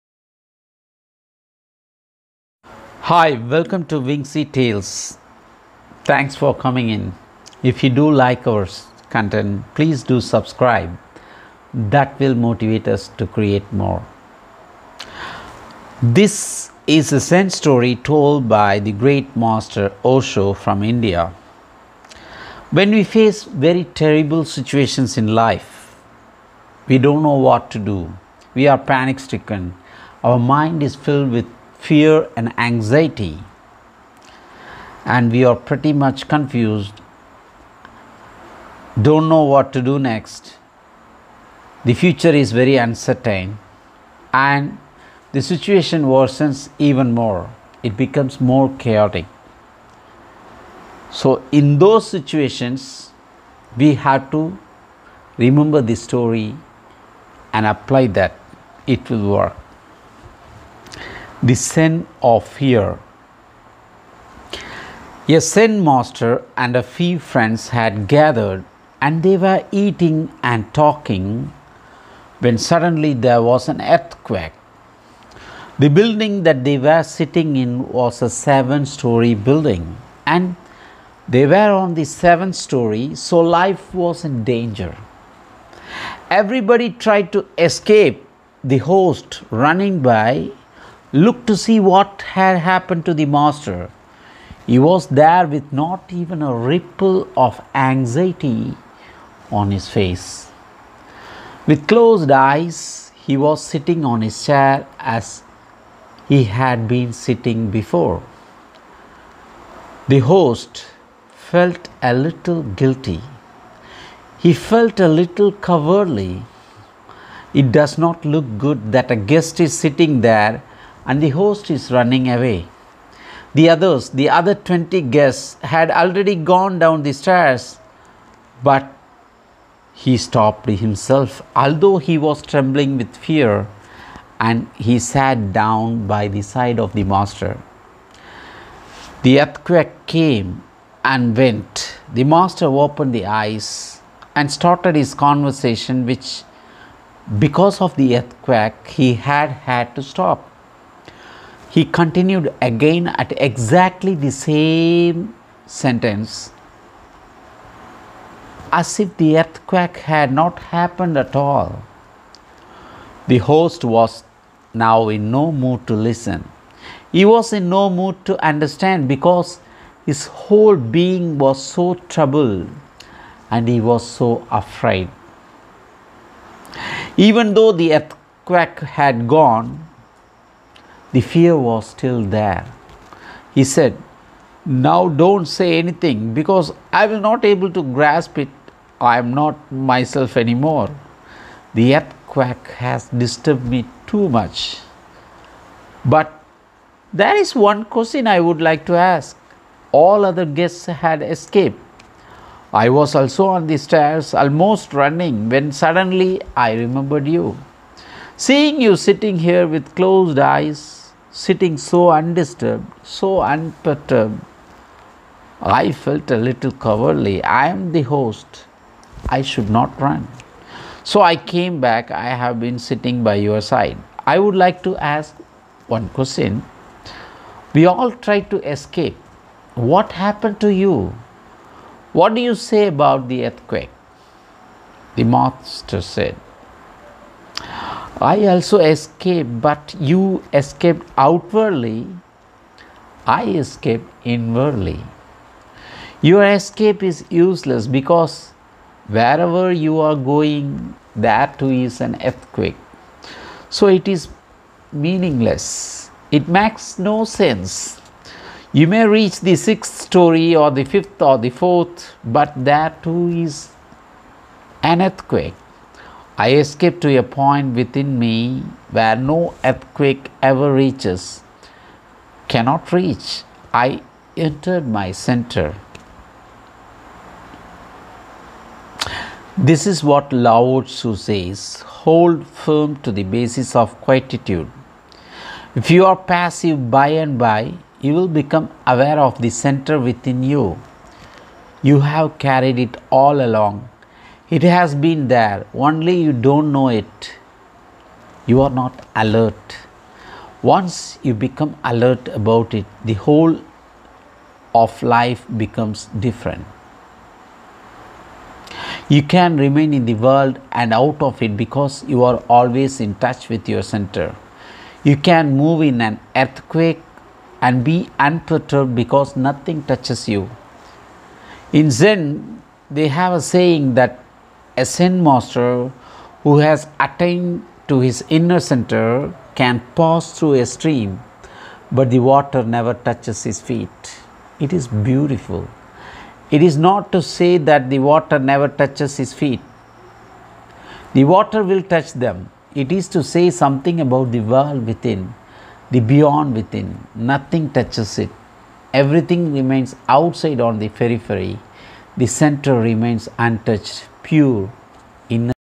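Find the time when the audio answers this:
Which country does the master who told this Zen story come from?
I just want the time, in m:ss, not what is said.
0:20.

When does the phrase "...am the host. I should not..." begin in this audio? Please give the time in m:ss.
3:37.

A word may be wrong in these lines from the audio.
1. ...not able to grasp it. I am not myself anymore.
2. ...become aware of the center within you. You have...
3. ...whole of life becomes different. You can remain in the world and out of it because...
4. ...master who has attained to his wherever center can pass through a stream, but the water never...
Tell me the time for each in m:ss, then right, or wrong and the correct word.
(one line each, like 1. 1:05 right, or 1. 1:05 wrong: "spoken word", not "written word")
1. 3:07 right
2. 4:48 right
3. 5:03 right
4. 5:25 wrong: "inner", not "wherever".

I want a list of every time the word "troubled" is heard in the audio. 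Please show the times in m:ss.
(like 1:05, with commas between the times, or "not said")
2:52.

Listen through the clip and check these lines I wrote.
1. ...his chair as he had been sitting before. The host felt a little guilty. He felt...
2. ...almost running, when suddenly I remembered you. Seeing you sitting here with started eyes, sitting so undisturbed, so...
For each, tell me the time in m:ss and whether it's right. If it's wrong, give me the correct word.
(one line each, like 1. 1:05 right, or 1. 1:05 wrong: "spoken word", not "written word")
1. 1:44 right
2. 3:24 wrong: "closed", not "started".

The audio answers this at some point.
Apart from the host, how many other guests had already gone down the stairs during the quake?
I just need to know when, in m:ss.
2:04.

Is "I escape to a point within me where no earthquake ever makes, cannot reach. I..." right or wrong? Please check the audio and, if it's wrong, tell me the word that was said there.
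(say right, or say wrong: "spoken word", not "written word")
wrong: "reaches", not "makes".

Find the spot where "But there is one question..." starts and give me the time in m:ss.
3:16.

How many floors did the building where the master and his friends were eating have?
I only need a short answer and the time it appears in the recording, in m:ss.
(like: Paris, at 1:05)
7, at 1:18.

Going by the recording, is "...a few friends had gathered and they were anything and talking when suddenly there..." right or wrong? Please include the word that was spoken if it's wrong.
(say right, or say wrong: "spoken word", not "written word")
wrong: "eating", not "anything".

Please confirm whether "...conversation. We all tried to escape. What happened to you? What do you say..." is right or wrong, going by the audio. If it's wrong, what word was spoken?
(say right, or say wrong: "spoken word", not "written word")
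wrong: "question", not "conversation".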